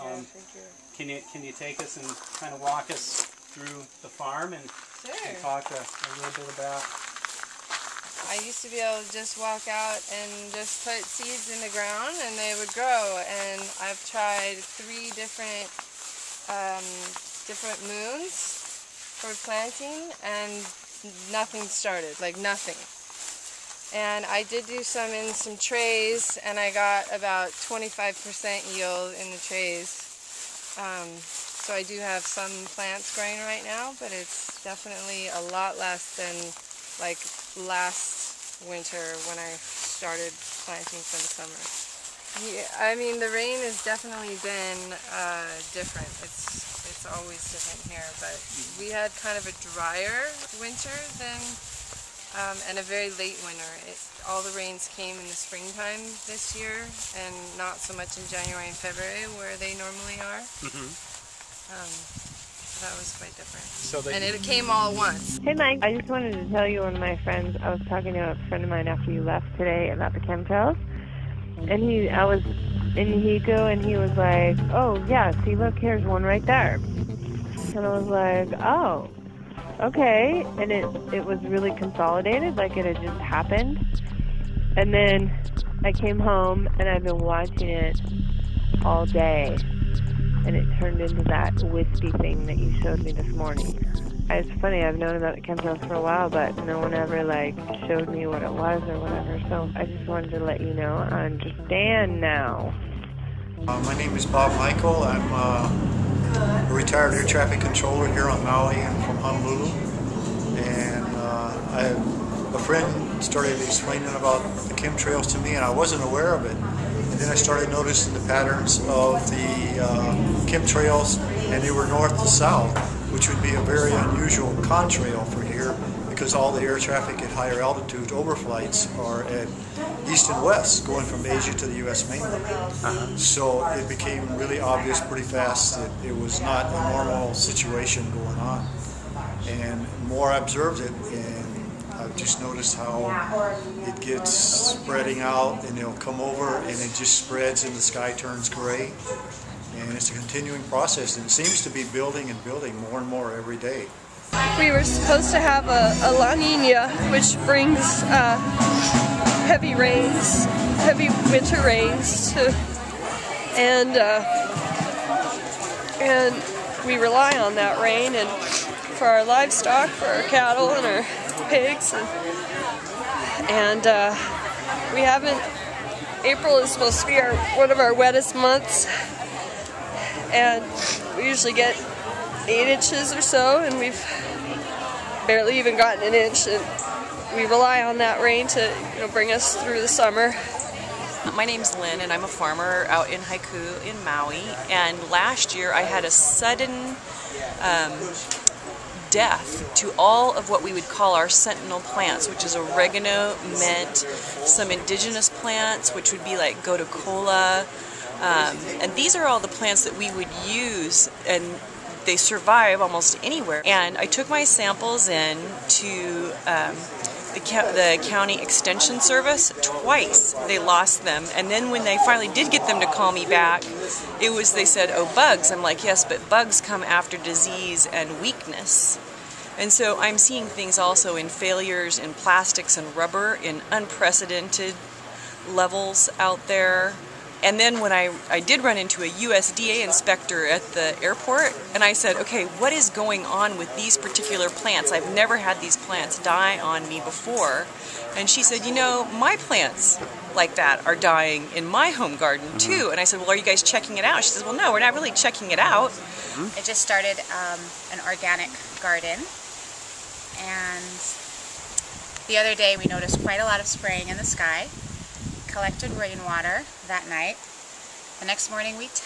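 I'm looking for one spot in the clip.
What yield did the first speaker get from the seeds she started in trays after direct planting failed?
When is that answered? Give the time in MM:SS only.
00:27.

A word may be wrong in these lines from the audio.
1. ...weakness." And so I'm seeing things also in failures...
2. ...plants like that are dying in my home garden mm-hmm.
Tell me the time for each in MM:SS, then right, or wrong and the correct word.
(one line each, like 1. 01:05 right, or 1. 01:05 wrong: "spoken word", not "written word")
1. 03:48 right
2. 04:09 right.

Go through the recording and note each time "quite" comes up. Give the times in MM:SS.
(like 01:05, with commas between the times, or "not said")
01:03, 04:23.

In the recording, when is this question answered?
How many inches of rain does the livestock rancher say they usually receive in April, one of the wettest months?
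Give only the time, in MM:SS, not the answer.
03:02.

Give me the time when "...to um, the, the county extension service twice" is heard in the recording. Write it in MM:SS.
03:35.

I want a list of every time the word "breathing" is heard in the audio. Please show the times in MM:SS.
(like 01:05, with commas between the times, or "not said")
not said.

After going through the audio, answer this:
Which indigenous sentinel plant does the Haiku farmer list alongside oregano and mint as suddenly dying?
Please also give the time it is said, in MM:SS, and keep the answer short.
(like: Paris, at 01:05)
gotu kola, at 03:26.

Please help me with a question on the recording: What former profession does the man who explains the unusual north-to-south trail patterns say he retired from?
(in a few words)
air traffic controller.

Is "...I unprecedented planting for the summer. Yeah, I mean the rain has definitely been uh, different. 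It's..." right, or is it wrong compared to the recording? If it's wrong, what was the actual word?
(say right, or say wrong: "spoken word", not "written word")
wrong: "started", not "unprecedented".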